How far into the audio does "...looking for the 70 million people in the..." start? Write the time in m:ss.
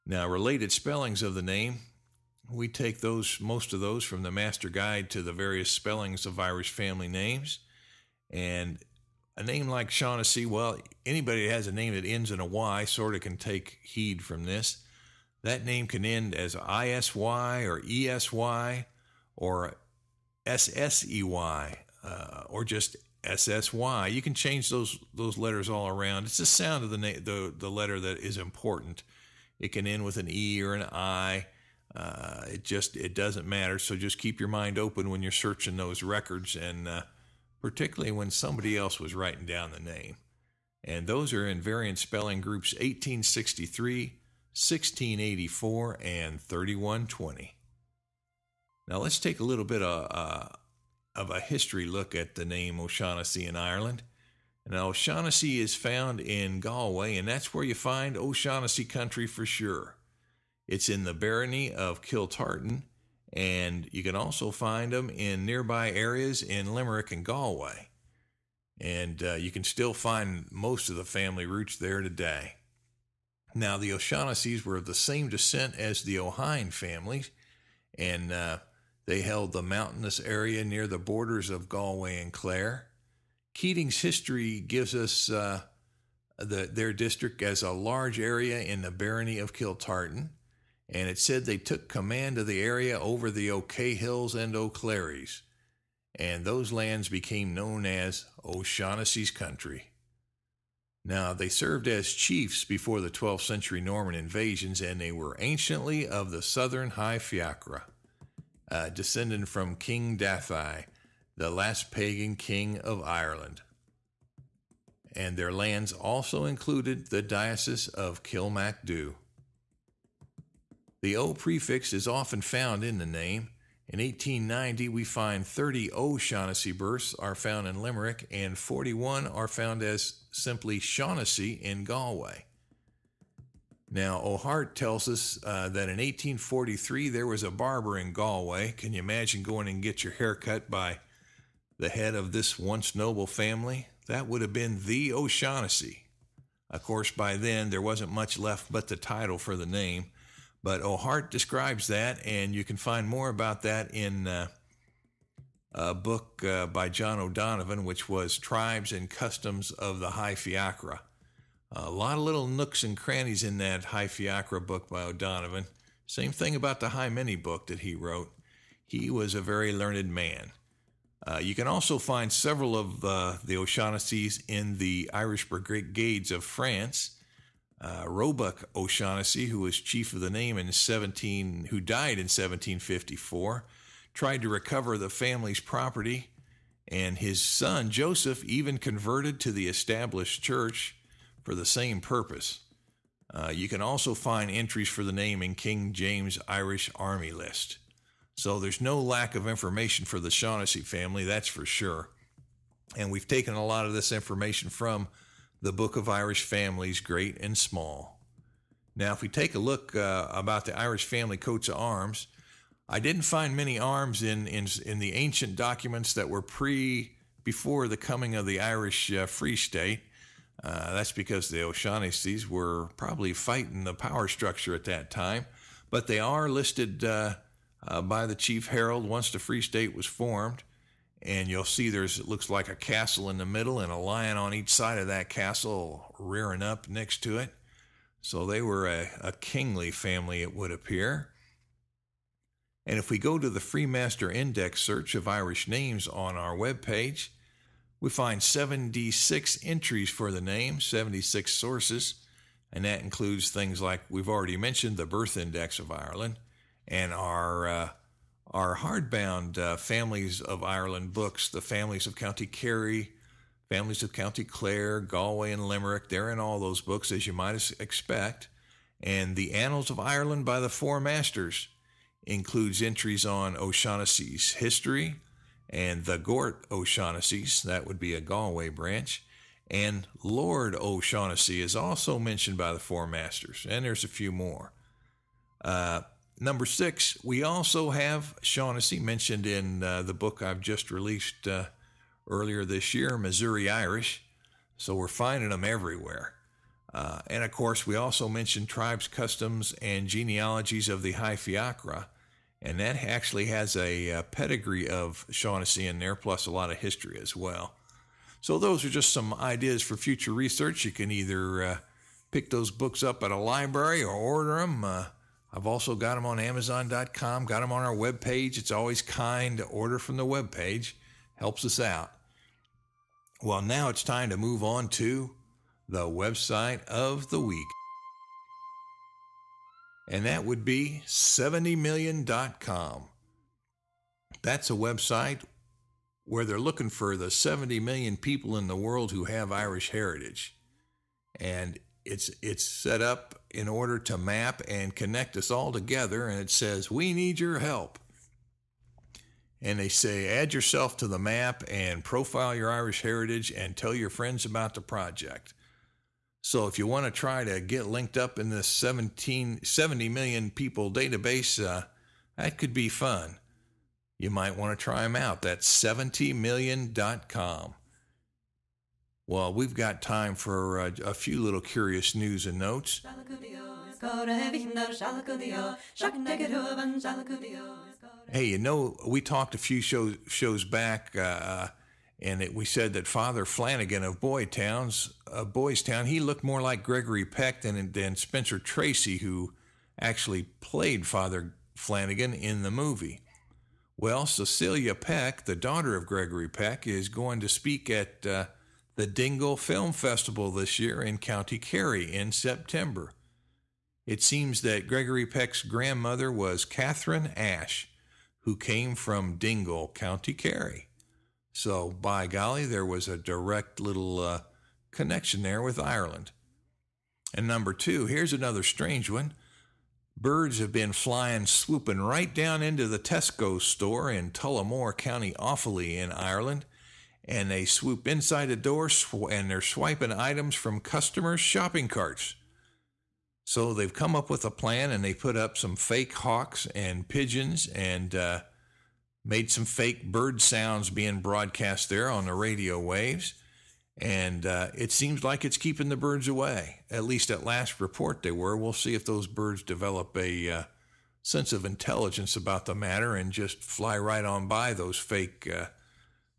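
5:36.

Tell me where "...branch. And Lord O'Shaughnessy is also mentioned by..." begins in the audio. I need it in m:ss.
4:38.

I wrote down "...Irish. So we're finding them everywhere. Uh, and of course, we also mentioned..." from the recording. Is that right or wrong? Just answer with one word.
right.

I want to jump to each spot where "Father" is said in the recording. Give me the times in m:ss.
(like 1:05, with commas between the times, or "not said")
6:23, 6:31.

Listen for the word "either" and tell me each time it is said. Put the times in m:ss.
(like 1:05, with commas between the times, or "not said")
5:11.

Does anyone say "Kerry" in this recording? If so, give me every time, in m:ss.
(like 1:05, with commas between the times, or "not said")
4:22, 6:41, 6:50.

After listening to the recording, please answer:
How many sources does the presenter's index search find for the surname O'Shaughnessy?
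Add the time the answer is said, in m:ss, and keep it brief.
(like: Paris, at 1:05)
76, at 4:10.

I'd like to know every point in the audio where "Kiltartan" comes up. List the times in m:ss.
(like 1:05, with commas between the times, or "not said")
1:02, 1:29.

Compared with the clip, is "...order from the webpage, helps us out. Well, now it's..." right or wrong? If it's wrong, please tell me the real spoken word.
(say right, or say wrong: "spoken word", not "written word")
right.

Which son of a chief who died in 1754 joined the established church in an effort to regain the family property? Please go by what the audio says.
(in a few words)
Joseph.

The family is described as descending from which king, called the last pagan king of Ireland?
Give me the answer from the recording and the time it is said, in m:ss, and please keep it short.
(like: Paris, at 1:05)
King Dathi, at 1:49.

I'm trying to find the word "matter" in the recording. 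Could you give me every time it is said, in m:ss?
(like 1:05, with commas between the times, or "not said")
0:33, 7:32.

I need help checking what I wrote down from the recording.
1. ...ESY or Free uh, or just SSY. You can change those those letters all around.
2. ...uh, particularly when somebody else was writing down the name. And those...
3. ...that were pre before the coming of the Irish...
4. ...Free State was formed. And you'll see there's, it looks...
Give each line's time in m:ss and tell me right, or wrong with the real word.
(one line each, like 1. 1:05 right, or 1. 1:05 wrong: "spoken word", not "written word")
1. 0:17 wrong: "SSEY", not "Free"
2. 0:36 right
3. 3:36 right
4. 3:49 right.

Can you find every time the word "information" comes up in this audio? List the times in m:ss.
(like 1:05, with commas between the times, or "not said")
3:19, 3:24.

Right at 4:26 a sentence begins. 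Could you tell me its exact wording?
They're in all those books, as you might expect.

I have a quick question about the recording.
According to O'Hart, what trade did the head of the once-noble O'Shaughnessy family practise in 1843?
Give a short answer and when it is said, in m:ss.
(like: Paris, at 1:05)
Barber, at 2:17.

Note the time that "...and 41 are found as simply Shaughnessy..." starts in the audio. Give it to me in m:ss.
2:08.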